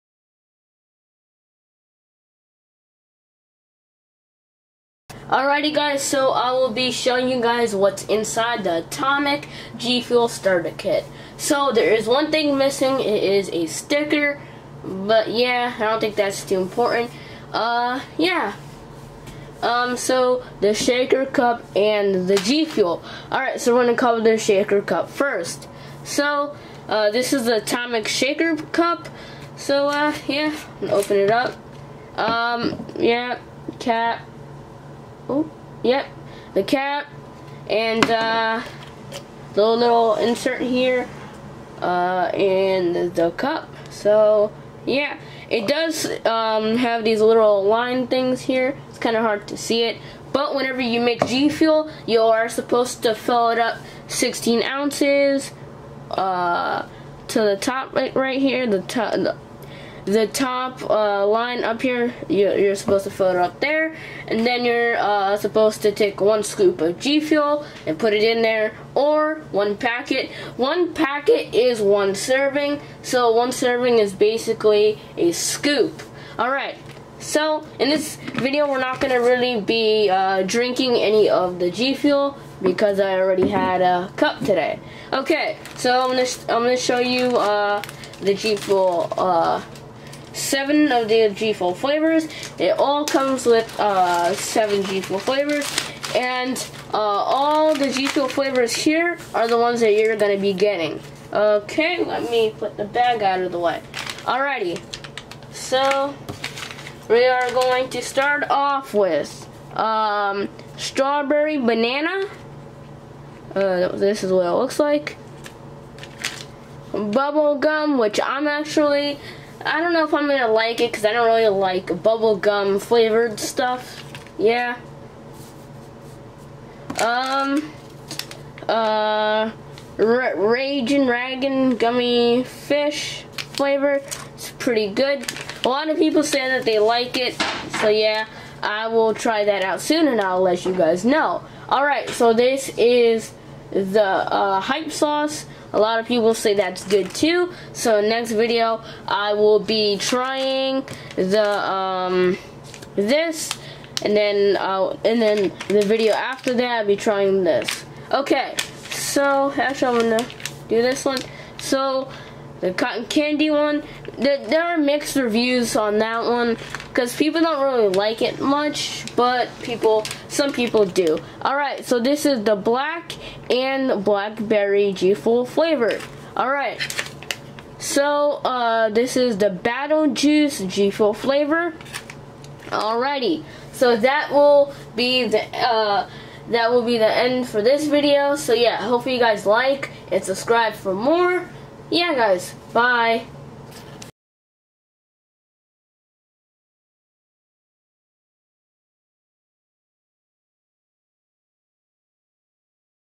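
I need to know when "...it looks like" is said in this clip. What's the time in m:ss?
1:54.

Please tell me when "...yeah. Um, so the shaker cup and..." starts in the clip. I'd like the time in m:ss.
0:18.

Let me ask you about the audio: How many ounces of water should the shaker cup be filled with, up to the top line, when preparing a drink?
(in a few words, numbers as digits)
16.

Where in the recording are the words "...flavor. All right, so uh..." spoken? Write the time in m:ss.
2:55.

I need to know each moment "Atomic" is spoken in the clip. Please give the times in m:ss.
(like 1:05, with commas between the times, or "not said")
0:08, 0:27.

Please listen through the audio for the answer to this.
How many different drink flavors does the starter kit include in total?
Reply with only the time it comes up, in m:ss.
1:34.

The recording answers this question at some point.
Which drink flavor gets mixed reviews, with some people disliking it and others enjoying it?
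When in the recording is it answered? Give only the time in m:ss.
2:42.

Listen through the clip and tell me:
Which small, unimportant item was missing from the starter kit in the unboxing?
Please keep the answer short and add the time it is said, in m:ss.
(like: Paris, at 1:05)
Sticker, at 0:13.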